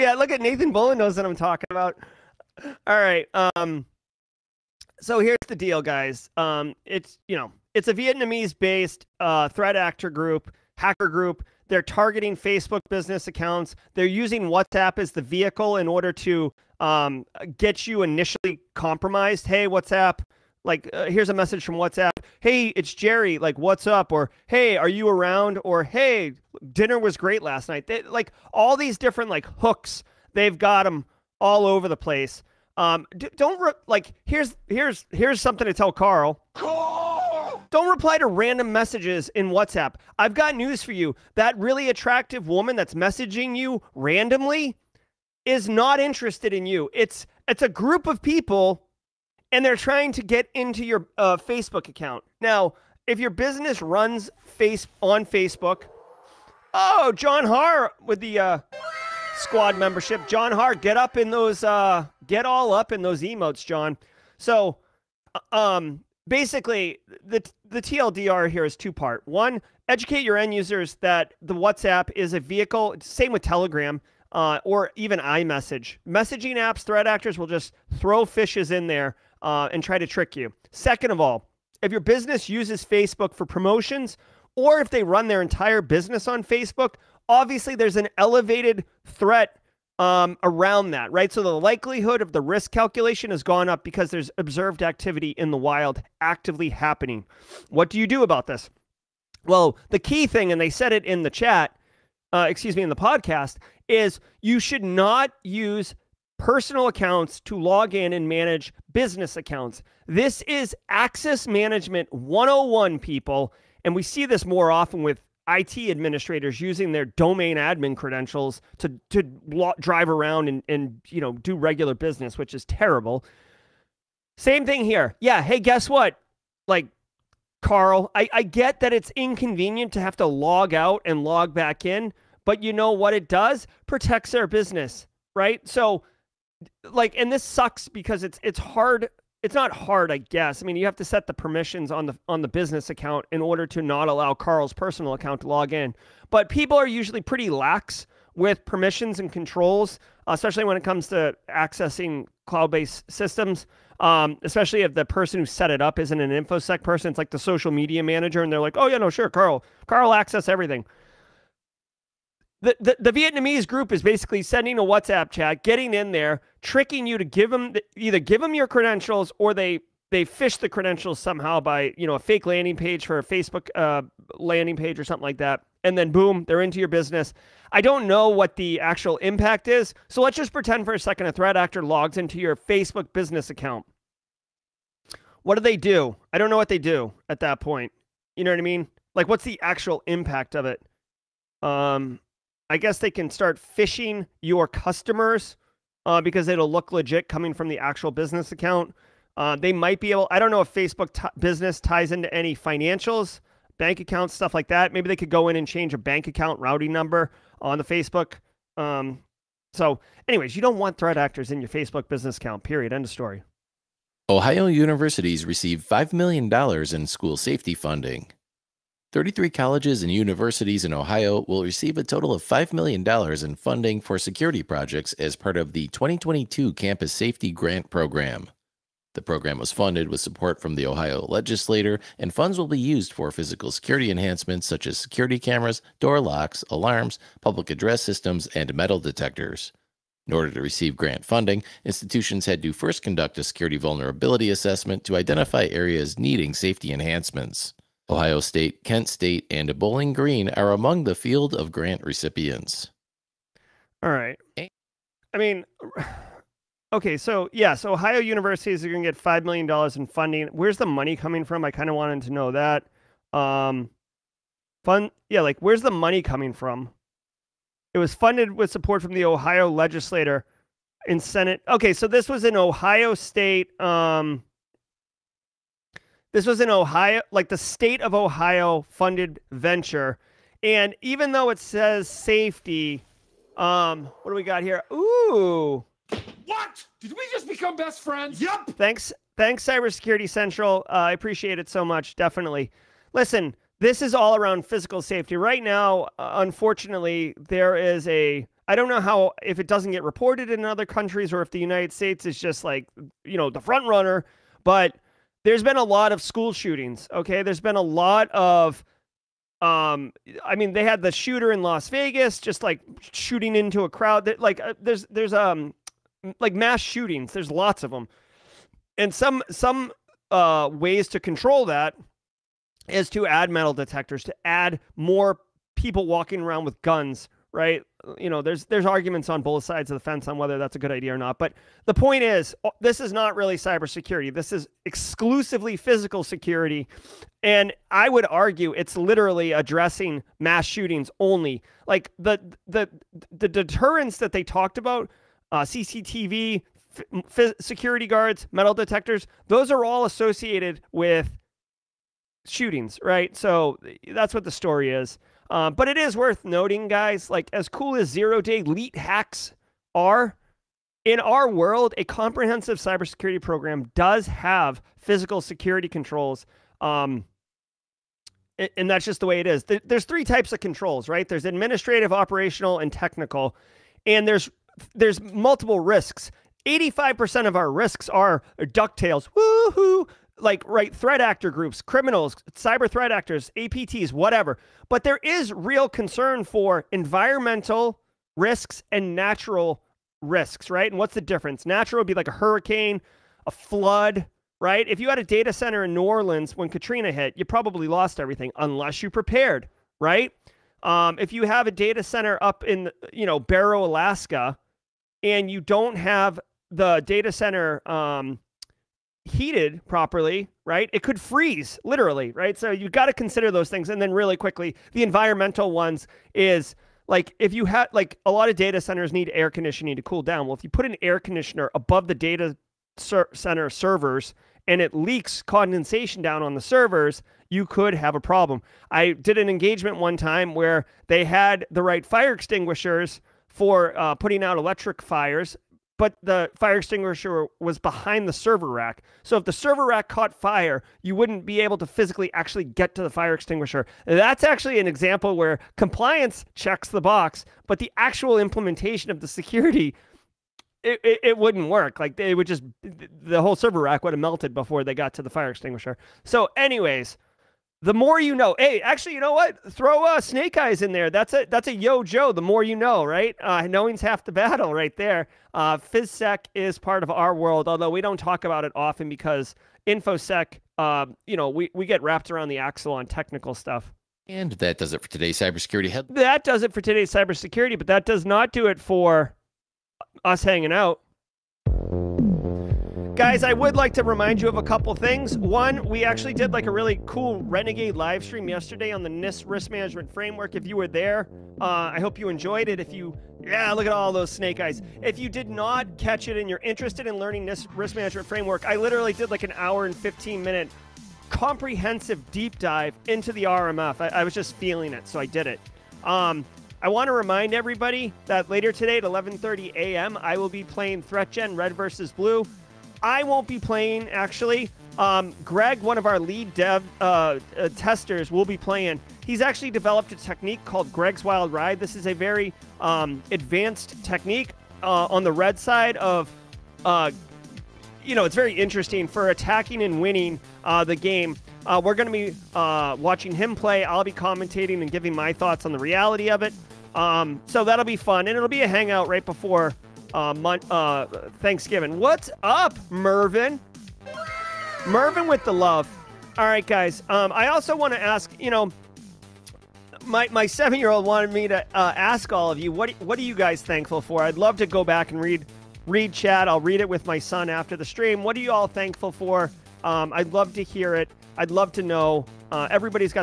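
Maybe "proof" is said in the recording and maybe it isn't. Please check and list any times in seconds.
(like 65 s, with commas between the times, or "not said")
not said.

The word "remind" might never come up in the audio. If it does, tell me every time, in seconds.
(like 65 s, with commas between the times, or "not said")
484 s, 507 s.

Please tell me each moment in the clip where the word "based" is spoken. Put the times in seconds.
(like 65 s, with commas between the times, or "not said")
7 s, 152 s.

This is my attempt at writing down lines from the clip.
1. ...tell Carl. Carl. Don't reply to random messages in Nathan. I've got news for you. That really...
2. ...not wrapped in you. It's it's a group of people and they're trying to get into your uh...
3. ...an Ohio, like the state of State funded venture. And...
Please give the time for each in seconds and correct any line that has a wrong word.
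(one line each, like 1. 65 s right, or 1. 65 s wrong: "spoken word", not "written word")
1. 35 s wrong: "WhatsApp", not "Nathan"
2. 45 s wrong: "interested", not "wrapped"
3. 276 s wrong: "Ohio", not "State".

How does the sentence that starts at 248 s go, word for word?
Ohio State, Kent State, and Bowling Green are among the field of grant recipients.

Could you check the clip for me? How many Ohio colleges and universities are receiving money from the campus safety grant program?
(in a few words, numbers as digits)
33.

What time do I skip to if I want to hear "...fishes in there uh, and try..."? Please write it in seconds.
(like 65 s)
78 s.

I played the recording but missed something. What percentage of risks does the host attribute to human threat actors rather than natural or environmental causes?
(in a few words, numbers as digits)
85%.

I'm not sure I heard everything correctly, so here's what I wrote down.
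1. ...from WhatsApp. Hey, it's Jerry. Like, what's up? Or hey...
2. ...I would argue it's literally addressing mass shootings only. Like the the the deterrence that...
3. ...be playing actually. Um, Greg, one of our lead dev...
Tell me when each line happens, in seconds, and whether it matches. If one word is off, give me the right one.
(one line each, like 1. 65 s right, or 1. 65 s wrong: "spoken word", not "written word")
1. 21 s right
2. 337 s right
3. 513 s right.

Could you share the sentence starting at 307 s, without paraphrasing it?
Okay, there's been a lot of, um, I mean, they had the shooter in Las Vegas just like shooting into a crowd.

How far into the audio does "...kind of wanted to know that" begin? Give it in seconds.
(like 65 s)
261 s.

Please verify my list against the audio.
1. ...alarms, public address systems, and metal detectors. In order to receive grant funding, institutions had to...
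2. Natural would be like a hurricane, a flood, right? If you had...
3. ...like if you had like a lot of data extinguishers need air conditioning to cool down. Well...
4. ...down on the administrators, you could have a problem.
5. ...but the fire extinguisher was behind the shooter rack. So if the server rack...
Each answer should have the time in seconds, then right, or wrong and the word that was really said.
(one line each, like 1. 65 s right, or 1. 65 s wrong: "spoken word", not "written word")
1. 236 s right
2. 391 s right
3. 417 s wrong: "centers", not "extinguishers"
4. 426 s wrong: "servers", not "administrators"
5. 436 s wrong: "server", not "shooter".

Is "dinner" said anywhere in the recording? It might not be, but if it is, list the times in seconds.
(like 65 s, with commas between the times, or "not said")
26 s.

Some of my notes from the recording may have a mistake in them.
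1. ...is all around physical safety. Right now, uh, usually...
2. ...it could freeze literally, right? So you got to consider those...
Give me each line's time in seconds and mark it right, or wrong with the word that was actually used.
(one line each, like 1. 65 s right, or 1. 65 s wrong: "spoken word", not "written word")
1. 294 s wrong: "unfortunately", not "usually"
2. 410 s right.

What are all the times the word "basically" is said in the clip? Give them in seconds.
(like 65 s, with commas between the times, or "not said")
66 s, 164 s.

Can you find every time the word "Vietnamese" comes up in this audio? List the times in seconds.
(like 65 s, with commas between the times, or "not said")
7 s, 163 s.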